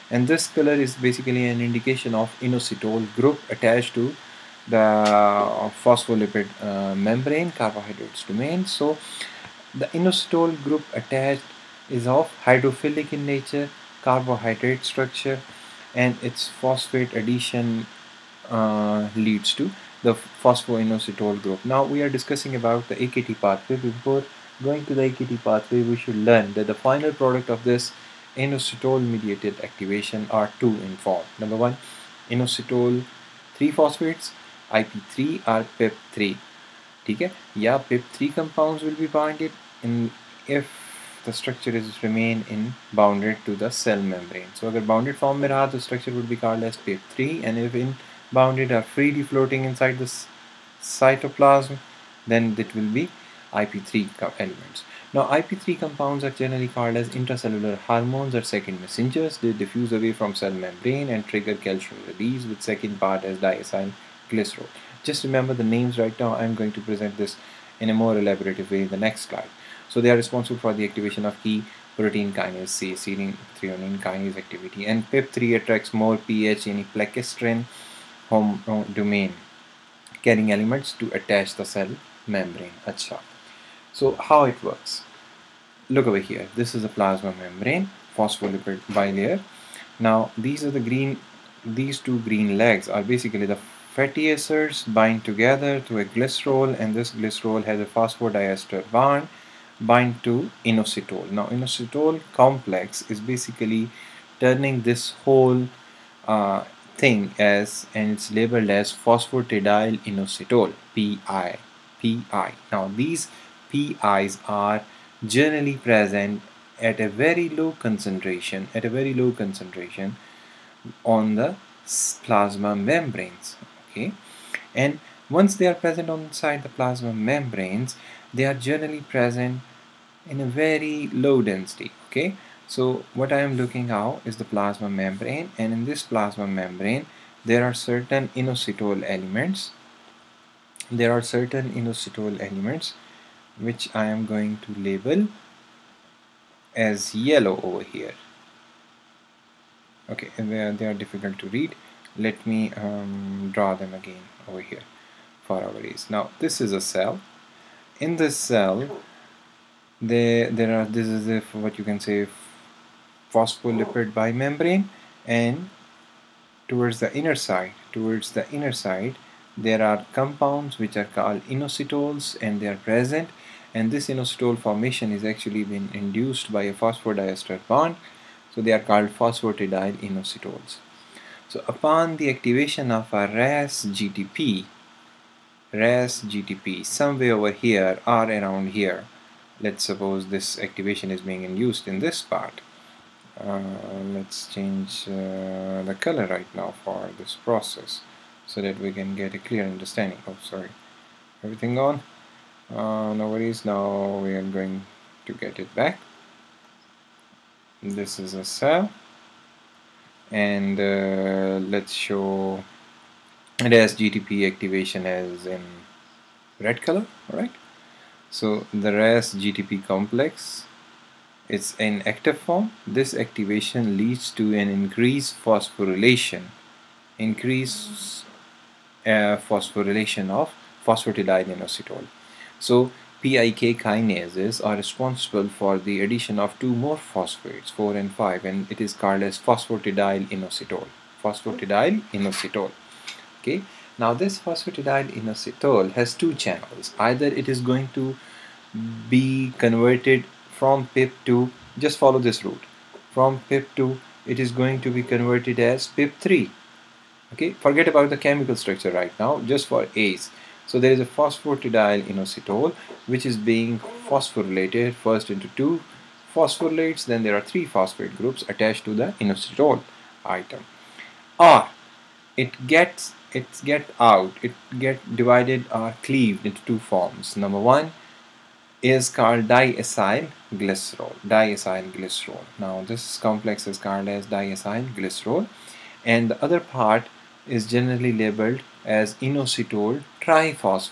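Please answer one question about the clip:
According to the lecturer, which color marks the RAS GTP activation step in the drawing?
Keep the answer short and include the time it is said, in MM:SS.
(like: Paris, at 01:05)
Red, at 03:36.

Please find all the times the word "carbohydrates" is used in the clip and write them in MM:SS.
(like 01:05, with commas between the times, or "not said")
00:07, 00:14.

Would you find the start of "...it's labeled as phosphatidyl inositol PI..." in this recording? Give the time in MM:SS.
01:48.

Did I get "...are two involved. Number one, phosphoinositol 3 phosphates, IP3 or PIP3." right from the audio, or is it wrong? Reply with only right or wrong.
wrong.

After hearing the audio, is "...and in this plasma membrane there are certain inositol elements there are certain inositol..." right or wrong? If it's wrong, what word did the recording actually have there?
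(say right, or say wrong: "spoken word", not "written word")
right.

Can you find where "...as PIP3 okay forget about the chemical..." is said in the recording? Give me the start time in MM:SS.
04:15.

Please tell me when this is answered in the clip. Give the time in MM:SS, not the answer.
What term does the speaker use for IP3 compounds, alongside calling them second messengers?
00:57.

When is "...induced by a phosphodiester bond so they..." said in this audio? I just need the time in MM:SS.
02:55.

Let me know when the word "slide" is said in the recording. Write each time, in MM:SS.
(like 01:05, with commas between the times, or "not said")
01:09.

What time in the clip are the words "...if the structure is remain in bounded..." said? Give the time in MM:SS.
00:40.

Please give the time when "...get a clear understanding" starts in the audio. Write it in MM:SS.
03:19.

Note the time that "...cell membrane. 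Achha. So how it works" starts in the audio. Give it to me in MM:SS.
01:21.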